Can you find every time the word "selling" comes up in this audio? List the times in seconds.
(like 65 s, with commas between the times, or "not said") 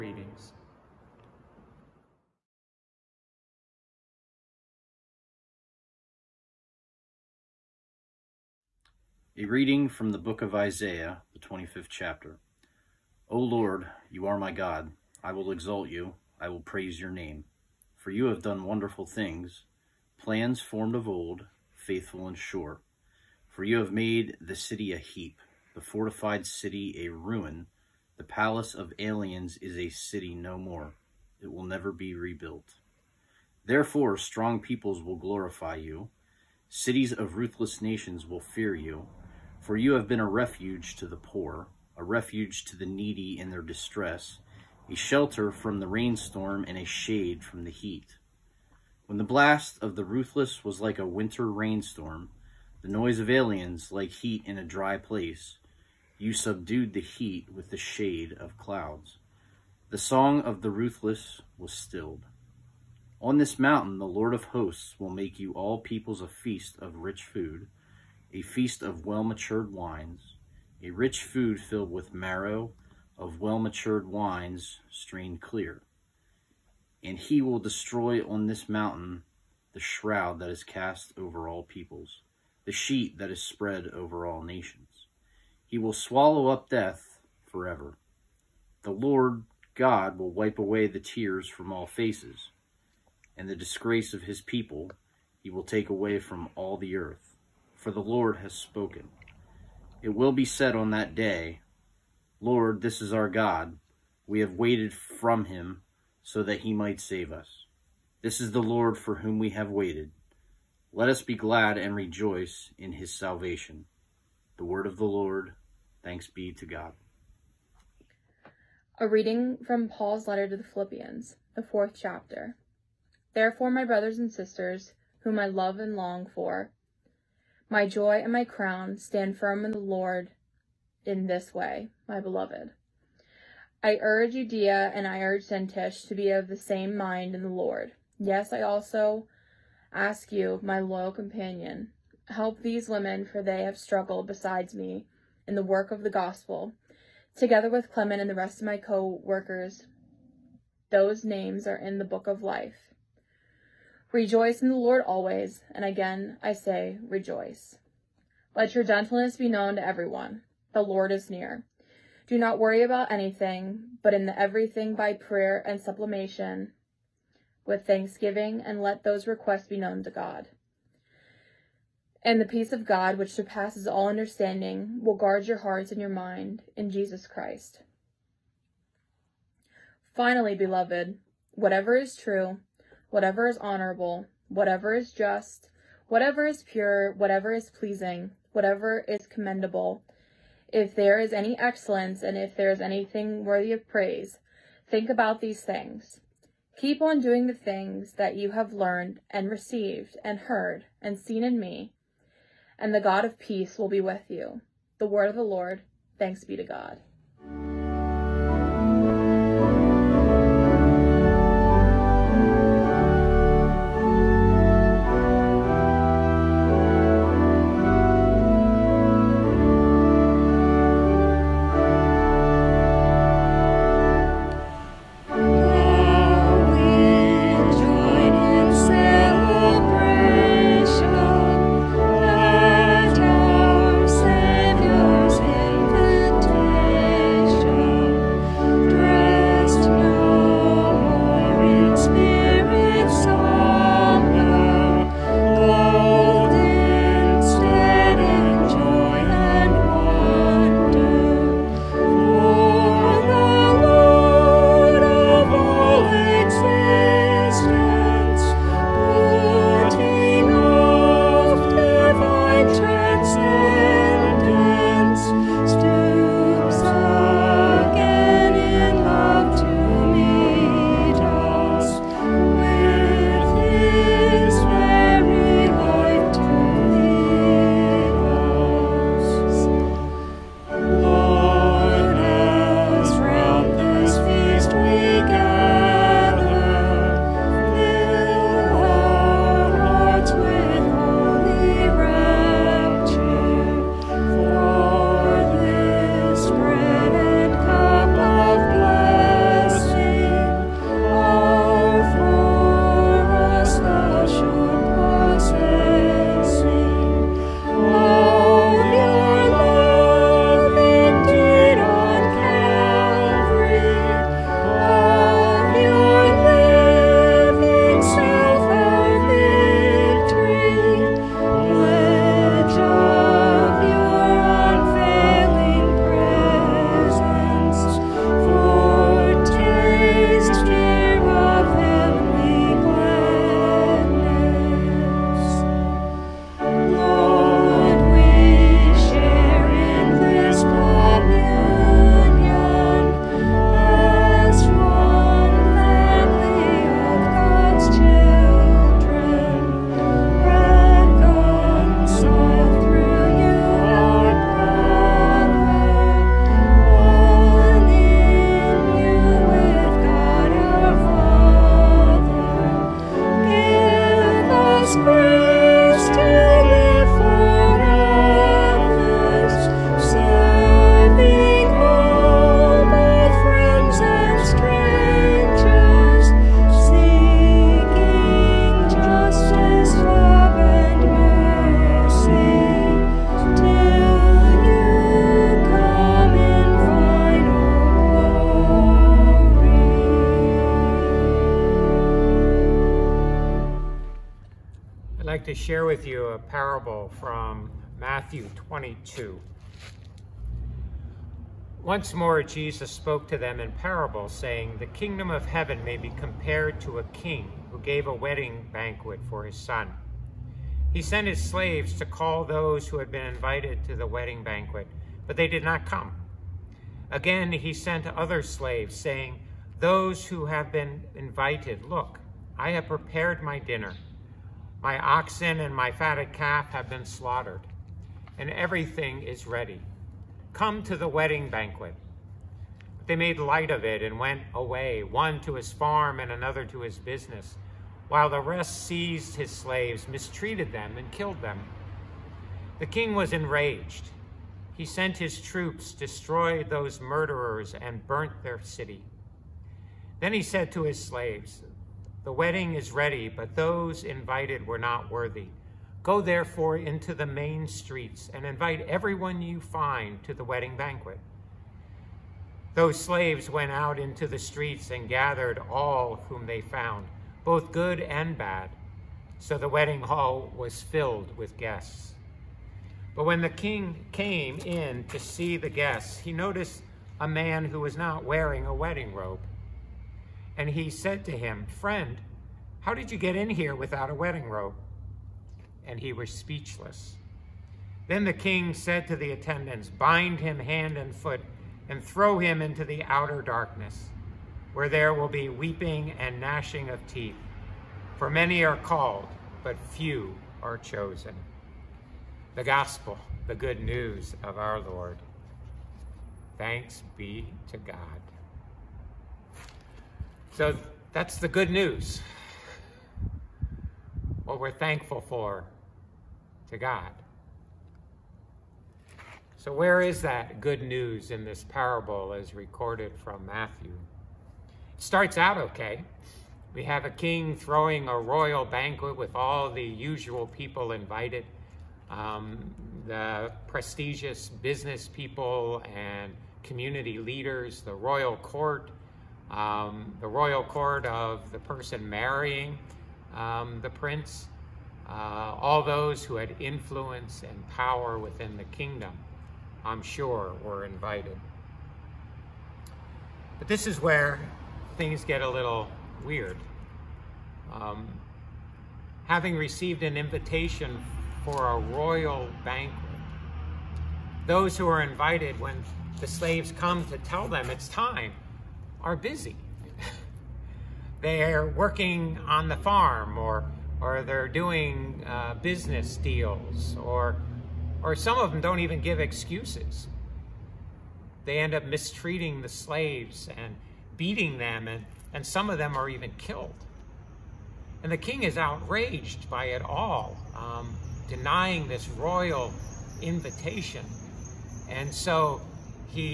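not said.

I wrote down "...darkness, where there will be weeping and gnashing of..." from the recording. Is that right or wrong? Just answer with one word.
right.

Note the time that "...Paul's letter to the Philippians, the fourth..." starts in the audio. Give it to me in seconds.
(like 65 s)
119 s.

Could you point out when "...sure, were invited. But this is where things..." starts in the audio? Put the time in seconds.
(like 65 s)
550 s.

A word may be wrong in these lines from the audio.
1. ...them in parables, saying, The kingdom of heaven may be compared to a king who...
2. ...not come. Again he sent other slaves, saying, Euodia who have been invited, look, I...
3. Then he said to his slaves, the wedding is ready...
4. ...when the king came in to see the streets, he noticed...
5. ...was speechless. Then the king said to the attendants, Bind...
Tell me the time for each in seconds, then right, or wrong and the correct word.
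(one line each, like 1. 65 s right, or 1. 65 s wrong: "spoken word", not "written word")
1. 403 s right
2. 415 s wrong: "Those", not "Euodia"
3. 450 s right
4. 473 s wrong: "guests", not "streets"
5. 486 s right.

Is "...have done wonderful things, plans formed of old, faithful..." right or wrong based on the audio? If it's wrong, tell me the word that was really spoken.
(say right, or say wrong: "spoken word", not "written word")
right.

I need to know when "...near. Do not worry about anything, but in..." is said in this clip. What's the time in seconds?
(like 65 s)
161 s.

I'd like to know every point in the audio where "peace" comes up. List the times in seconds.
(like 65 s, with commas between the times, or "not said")
172 s, 203 s.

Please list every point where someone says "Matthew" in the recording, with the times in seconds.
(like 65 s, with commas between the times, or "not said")
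397 s, 523 s.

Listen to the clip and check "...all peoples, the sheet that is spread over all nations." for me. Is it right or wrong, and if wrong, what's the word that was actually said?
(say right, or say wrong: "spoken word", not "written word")
right.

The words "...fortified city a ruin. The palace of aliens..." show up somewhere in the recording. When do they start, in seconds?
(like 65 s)
25 s.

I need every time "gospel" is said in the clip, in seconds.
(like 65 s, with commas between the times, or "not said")
146 s, 502 s.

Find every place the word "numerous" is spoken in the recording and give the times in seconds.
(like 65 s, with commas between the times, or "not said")
not said.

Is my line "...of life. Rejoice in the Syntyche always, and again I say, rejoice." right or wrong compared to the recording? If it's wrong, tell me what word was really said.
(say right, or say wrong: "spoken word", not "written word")
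wrong: "Lord", not "Syntyche".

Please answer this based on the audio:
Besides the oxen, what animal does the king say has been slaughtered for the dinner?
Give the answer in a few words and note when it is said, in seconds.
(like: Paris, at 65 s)
Fatted calf, at 425 s.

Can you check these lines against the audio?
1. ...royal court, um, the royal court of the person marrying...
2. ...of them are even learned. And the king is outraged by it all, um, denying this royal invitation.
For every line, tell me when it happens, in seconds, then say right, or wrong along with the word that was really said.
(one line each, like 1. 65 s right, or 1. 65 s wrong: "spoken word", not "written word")
1. 537 s right
2. 585 s wrong: "killed", not "learned".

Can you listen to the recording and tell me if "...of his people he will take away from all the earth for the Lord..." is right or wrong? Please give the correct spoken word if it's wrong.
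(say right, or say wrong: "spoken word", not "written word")
right.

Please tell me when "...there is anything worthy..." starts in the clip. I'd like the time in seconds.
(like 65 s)
192 s.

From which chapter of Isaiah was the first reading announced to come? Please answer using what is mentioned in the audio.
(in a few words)
25th.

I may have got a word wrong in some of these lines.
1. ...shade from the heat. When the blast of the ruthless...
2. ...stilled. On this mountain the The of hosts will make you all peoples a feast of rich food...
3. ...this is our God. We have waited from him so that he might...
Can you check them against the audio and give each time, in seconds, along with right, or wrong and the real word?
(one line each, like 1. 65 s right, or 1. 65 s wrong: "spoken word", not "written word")
1. 46 s right
2. 61 s wrong: "Lord", not "The"
3. 102 s right.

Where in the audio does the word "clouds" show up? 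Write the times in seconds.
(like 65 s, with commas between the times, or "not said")
58 s.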